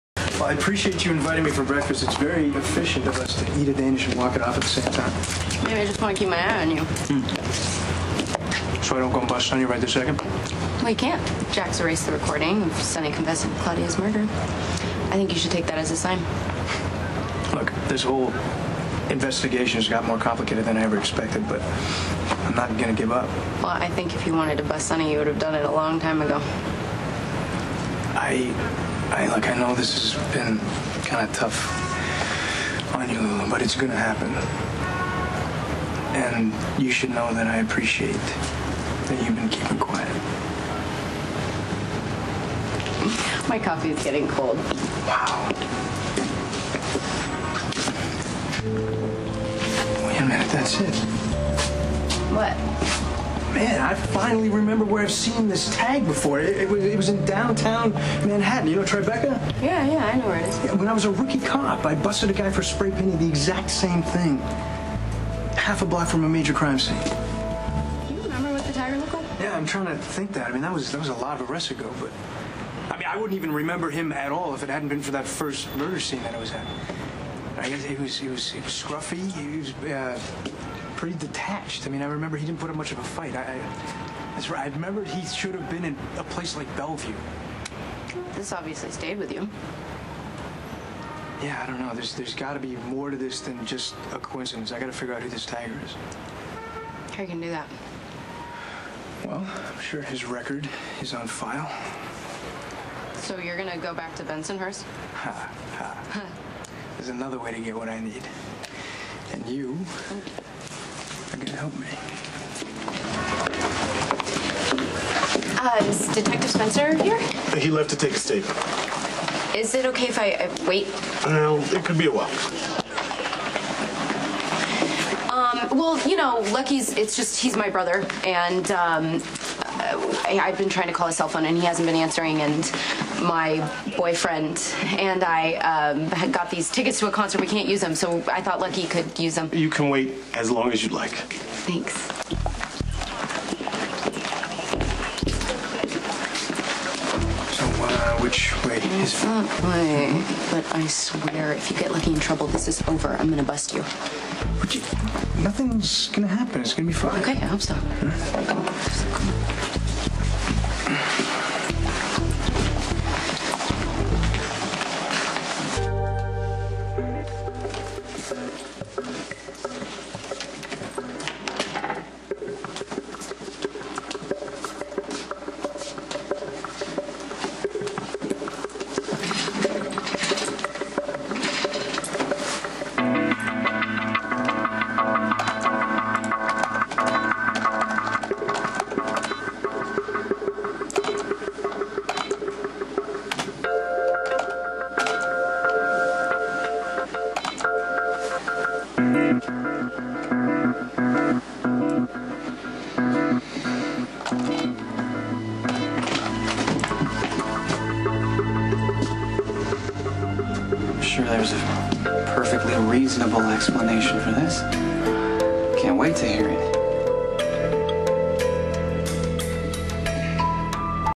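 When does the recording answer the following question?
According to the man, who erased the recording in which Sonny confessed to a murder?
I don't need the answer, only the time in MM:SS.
00:11.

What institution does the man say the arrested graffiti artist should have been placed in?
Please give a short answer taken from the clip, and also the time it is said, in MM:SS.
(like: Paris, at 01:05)
Bellevue, at 01:26.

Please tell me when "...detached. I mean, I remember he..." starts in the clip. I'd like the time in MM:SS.
01:21.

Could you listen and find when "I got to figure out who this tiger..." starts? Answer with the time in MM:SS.
01:34.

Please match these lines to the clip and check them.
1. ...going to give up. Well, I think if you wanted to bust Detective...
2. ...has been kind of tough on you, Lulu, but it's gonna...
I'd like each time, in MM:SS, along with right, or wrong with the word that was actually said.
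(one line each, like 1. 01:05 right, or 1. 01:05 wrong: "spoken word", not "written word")
1. 00:22 wrong: "Sonny", not "Detective"
2. 00:30 right.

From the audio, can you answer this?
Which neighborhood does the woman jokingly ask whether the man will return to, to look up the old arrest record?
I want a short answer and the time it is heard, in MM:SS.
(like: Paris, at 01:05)
Bensonhurst, at 01:44.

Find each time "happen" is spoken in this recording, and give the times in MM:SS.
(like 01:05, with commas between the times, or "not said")
00:33, 02:36.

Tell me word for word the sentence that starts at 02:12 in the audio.
And my boyfriend and I um, got these tickets to a concert.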